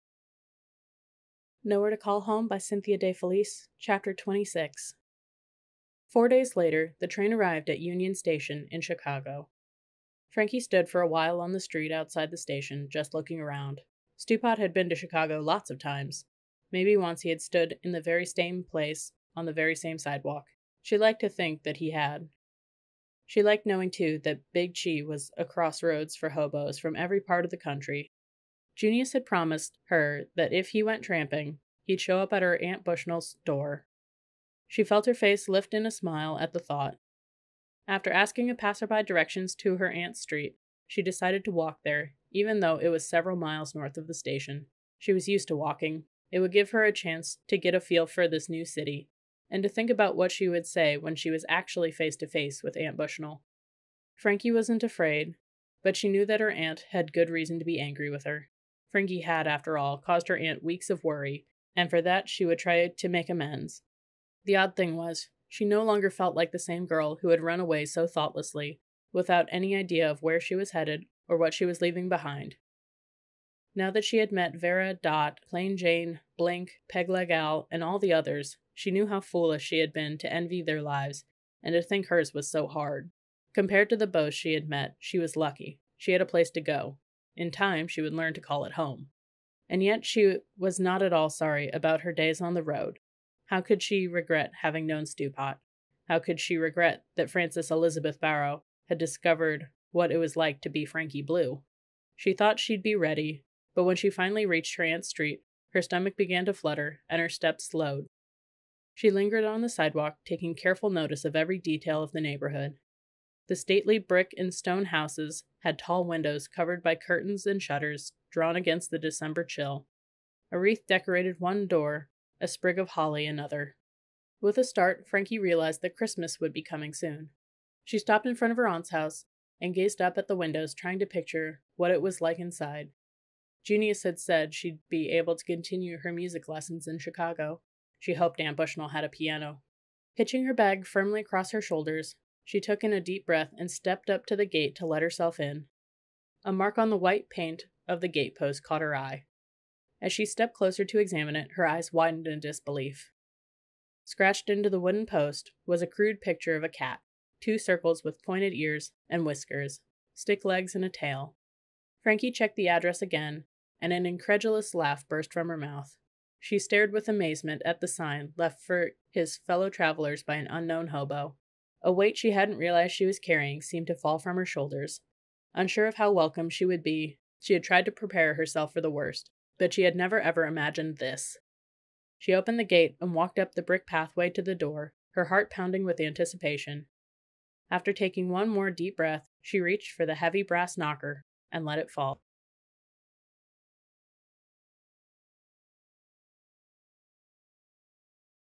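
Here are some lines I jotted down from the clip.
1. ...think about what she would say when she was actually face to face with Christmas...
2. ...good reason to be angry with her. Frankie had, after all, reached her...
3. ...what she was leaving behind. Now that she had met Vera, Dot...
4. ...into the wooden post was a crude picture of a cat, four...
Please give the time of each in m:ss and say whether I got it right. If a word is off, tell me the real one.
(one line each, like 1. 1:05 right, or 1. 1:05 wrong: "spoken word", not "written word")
1. 0:49 wrong: "Aunt", not "Christmas"
2. 0:57 wrong: "caused", not "reached"
3. 1:11 right
4. 2:34 wrong: "two", not "four".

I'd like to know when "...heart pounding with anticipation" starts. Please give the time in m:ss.
3:05.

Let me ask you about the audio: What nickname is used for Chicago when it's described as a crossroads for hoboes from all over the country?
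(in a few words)
Big Chi.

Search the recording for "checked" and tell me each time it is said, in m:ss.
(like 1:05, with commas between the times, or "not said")
2:42.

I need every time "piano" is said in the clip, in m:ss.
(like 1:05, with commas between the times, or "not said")
2:19.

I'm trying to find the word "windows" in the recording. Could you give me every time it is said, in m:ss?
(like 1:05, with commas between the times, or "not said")
1:56, 2:10.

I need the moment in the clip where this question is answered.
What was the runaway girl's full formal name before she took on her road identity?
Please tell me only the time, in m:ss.
1:37.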